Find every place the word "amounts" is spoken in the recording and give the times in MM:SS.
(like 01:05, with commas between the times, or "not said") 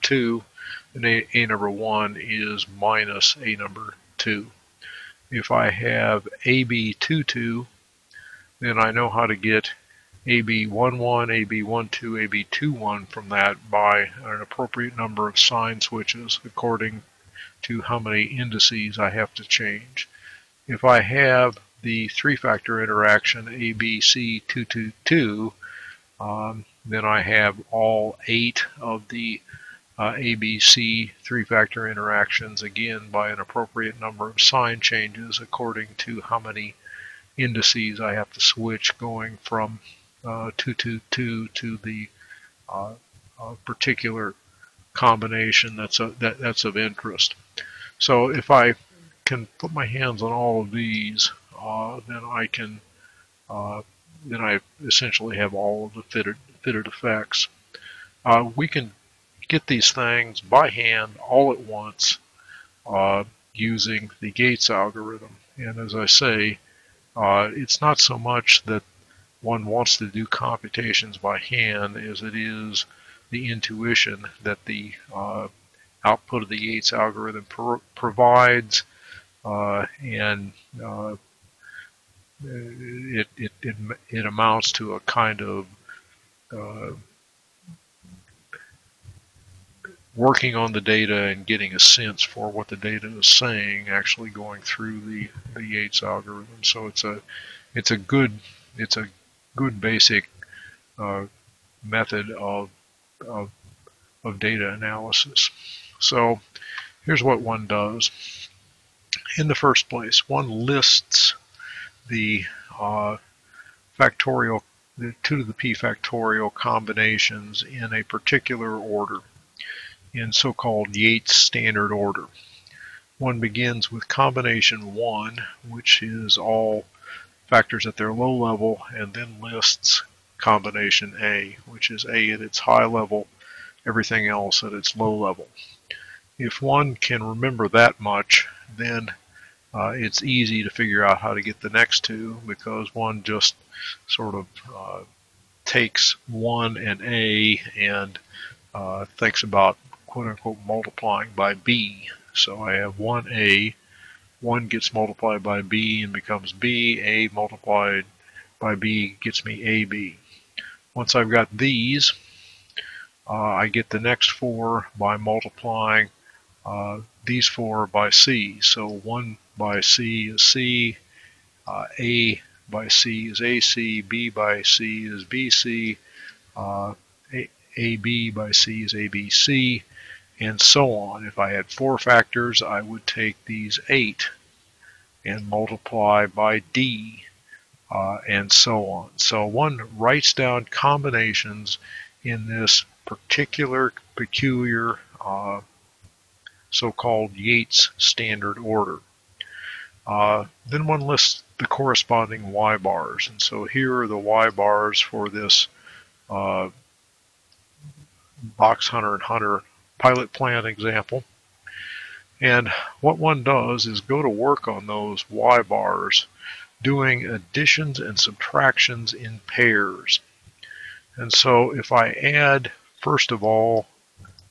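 01:24.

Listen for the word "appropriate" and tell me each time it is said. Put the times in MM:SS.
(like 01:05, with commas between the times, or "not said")
00:14, 00:33.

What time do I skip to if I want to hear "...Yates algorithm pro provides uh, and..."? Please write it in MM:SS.
01:16.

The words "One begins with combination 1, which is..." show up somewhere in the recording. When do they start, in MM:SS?
02:03.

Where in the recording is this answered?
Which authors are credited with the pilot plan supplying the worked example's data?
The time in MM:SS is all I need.
03:28.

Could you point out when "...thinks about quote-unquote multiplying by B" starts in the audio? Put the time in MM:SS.
02:29.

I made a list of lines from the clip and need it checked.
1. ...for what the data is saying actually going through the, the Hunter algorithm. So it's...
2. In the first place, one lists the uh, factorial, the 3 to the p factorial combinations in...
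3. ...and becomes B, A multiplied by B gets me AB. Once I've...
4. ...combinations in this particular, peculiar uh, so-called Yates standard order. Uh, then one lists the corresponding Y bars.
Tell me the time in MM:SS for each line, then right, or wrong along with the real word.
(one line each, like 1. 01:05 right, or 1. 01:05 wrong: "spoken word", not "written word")
1. 01:32 wrong: "Yates", not "Hunter"
2. 01:49 wrong: "2", not "3"
3. 02:36 right
4. 03:10 right.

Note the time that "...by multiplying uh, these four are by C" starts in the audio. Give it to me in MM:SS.
02:44.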